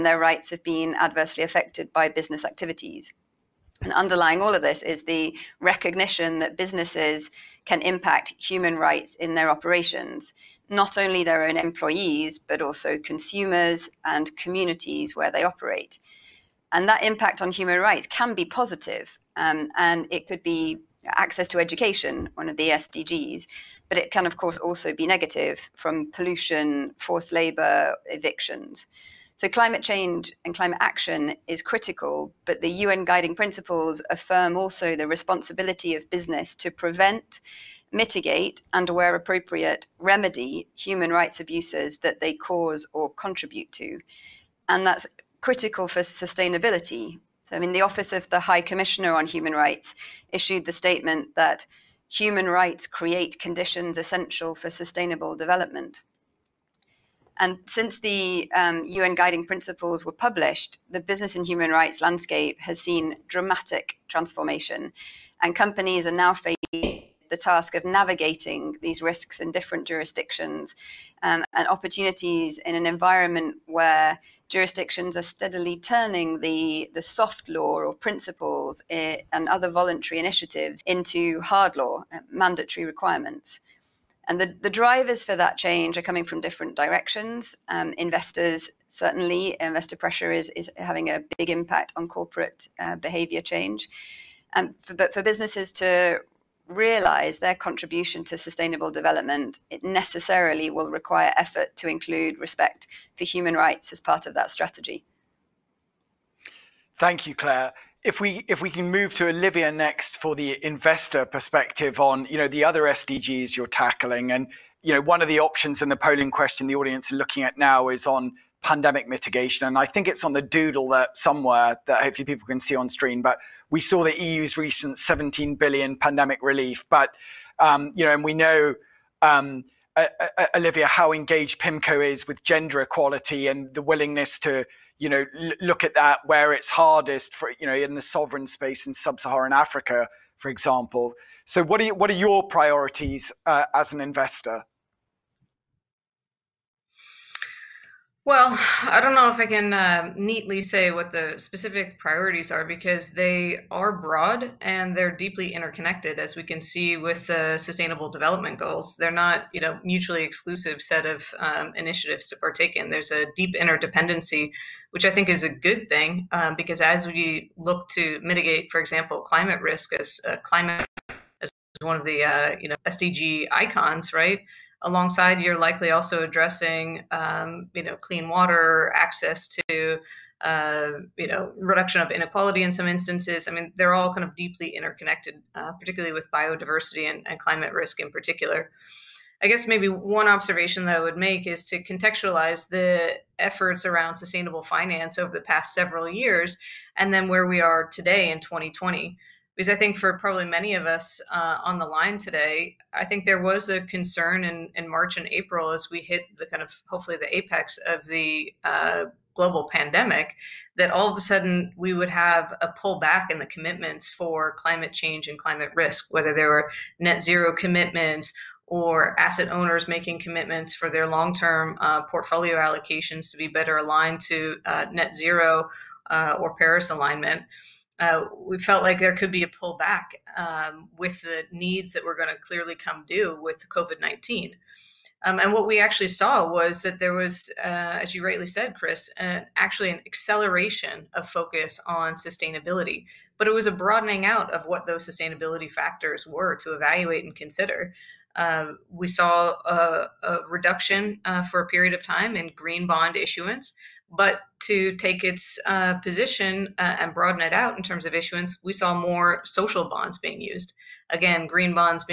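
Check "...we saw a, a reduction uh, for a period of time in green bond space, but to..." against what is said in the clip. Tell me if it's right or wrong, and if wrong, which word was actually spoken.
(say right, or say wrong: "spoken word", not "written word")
wrong: "issuance", not "space".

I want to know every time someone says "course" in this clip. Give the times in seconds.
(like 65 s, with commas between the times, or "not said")
24 s.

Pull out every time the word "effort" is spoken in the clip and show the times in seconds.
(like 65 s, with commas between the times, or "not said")
101 s, 193 s.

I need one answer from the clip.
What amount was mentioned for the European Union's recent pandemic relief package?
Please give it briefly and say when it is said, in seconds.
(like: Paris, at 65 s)
17 billion, at 124 s.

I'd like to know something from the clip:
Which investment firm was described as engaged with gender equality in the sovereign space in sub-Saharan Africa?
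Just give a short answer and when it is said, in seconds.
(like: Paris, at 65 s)
PIMCO, at 131 s.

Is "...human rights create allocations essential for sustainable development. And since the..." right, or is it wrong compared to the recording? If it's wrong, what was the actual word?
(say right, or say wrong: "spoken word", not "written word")
wrong: "conditions", not "allocations".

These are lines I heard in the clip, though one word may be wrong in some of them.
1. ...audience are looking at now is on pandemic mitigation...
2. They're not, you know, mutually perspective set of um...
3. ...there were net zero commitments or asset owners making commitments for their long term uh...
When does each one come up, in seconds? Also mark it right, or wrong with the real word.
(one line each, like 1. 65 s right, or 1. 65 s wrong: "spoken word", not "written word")
1. 116 s right
2. 158 s wrong: "exclusive", not "perspective"
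3. 216 s right.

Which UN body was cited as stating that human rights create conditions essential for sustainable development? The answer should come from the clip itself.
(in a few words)
Office of the High Commissioner on Human Rights.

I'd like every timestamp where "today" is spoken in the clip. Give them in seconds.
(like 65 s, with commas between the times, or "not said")
197 s, 202 s.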